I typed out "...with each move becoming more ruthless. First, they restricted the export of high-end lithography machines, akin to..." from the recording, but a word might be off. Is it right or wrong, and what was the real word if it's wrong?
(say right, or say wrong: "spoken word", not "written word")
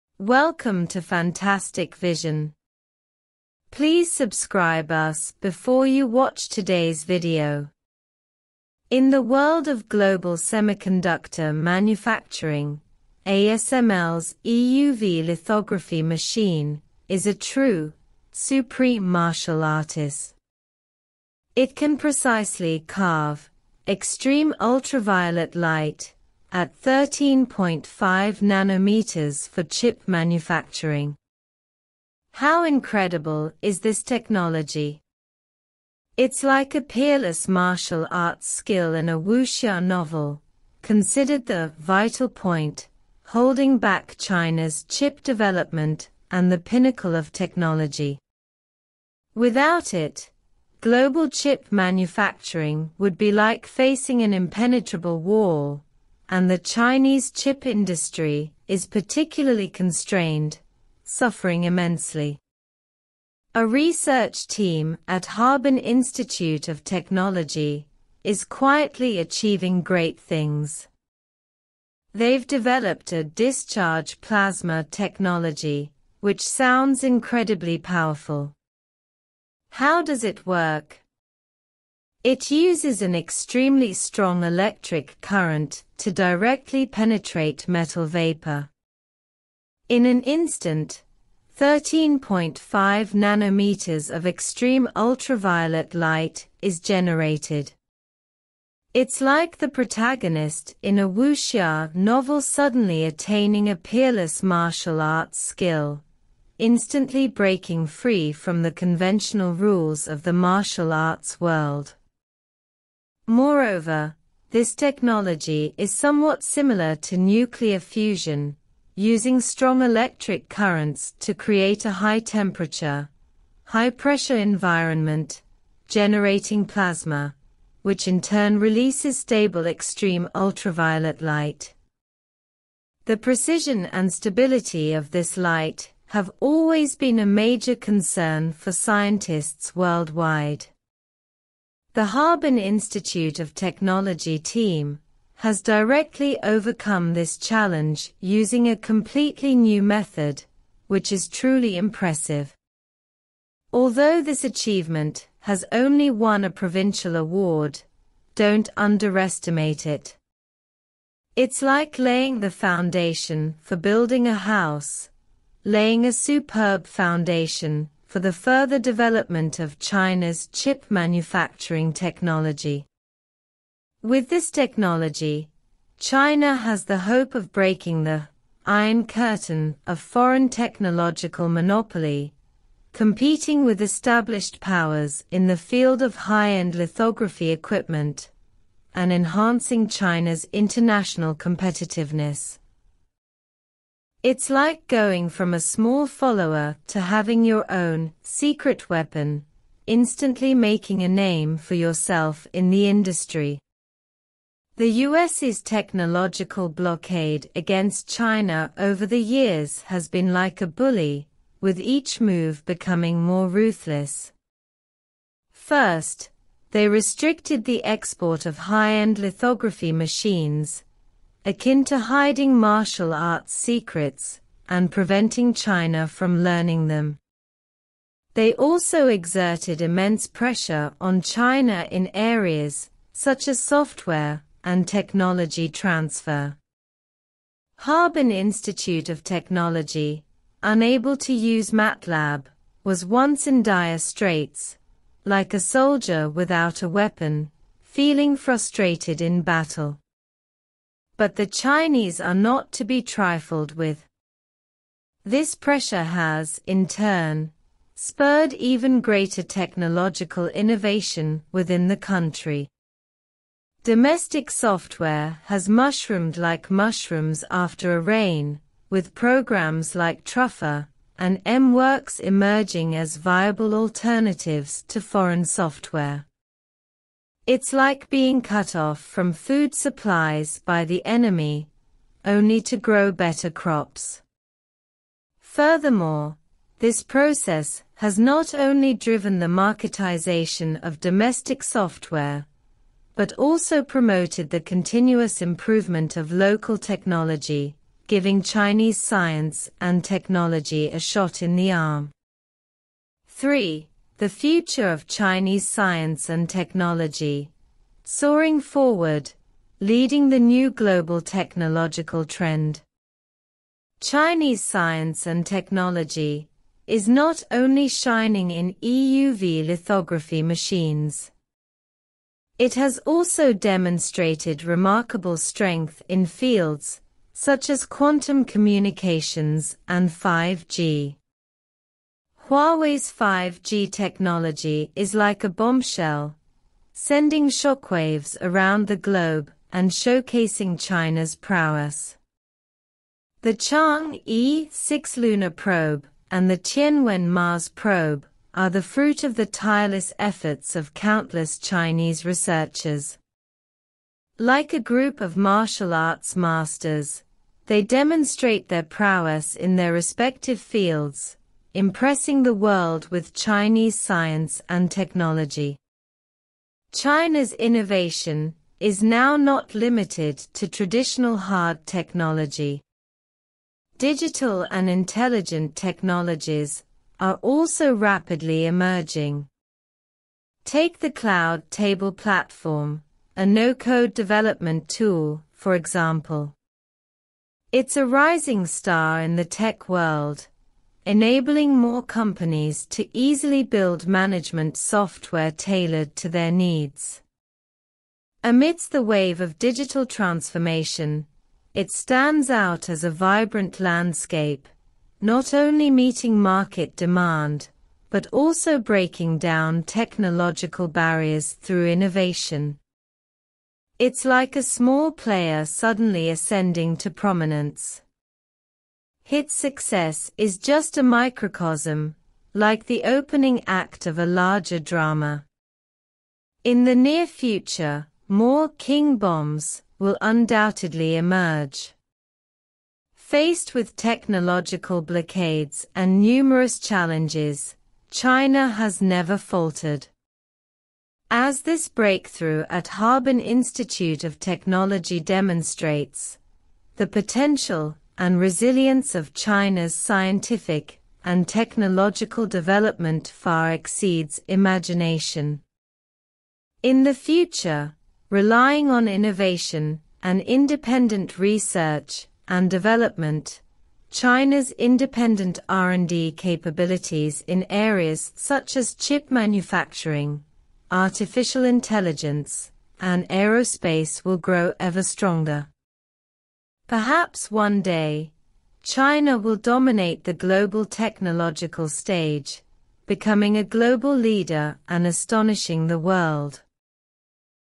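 right.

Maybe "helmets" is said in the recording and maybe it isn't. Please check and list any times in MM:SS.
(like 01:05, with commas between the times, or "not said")
not said.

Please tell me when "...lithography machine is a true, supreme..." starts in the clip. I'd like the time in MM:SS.
00:15.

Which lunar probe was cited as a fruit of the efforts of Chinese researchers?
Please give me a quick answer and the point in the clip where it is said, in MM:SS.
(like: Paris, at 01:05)
Chang'e 6, at 05:43.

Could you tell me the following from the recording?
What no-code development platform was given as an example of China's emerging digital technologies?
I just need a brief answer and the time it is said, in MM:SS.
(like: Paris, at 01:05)
Cloud Table, at 06:21.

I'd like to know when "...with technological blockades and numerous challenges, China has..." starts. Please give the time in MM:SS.
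07:13.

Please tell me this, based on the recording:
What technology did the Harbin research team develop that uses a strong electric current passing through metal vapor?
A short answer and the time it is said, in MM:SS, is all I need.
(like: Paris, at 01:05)
discharge plasma technology, at 01:13.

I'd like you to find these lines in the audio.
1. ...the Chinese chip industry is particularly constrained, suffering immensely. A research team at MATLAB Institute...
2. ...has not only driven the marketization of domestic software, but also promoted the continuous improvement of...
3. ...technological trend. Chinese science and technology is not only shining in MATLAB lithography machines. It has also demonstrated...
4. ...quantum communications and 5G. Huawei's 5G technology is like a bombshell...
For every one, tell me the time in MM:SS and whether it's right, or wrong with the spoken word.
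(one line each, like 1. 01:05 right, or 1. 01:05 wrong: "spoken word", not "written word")
1. 00:56 wrong: "Harbin", not "MATLAB"
2. 04:47 right
3. 05:11 wrong: "EUV", not "MATLAB"
4. 05:27 right.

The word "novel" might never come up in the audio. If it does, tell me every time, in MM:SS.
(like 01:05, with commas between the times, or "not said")
00:39, 01:41.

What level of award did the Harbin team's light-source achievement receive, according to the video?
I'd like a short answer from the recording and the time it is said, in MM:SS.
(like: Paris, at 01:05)
provincial, at 02:36.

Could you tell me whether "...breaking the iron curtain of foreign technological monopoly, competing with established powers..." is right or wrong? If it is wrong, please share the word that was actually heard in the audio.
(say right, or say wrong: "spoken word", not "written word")
right.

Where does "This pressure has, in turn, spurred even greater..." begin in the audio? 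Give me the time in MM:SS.
04:15.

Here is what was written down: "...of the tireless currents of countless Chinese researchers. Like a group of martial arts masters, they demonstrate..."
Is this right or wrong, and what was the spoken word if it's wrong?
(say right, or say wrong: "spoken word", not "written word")
wrong: "efforts", not "currents".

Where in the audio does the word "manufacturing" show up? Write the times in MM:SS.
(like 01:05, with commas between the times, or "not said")
00:11, 00:30, 00:51, 02:50, 07:49.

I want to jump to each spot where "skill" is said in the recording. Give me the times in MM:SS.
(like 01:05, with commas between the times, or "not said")
00:38, 01:45.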